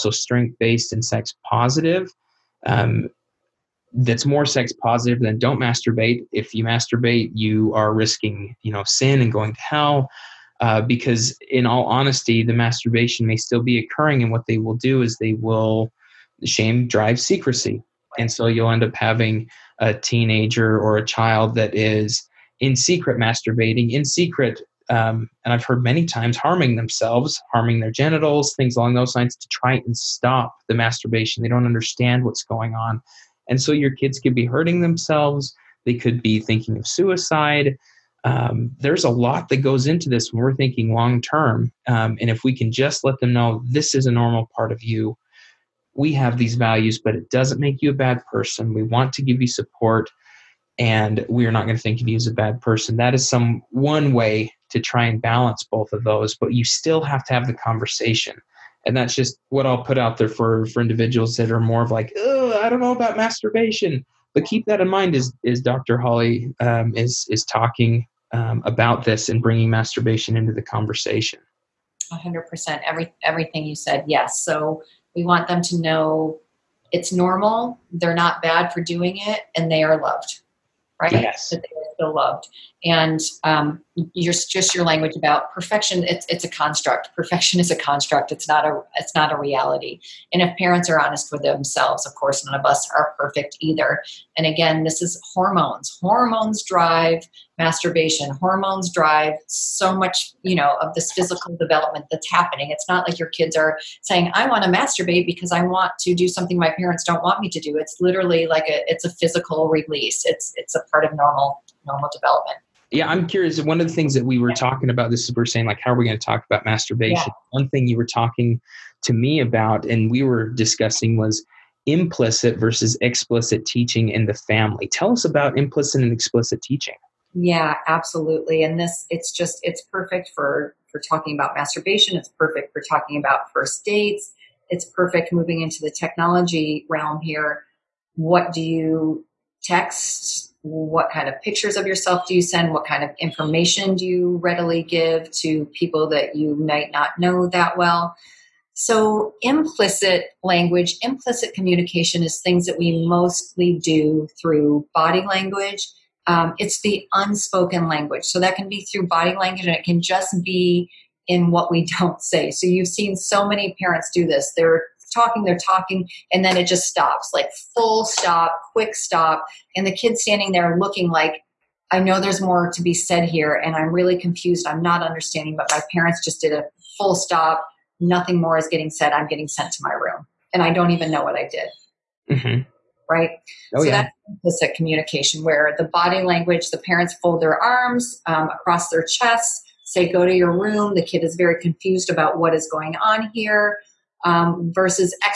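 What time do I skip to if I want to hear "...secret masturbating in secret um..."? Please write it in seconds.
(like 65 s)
22 s.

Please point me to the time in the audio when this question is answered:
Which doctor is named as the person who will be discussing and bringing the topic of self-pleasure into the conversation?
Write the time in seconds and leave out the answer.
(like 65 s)
65 s.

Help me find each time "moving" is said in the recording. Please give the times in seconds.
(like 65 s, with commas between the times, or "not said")
135 s.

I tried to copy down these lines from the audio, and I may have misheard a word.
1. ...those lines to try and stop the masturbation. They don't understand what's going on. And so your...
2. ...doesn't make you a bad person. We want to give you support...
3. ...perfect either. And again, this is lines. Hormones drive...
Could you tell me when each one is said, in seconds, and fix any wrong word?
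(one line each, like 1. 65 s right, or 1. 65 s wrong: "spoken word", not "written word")
1. 28 s right
2. 47 s right
3. 93 s wrong: "hormones", not "lines".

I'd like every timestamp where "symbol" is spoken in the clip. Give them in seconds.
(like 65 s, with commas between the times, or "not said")
not said.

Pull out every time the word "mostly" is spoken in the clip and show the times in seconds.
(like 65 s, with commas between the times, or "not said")
153 s.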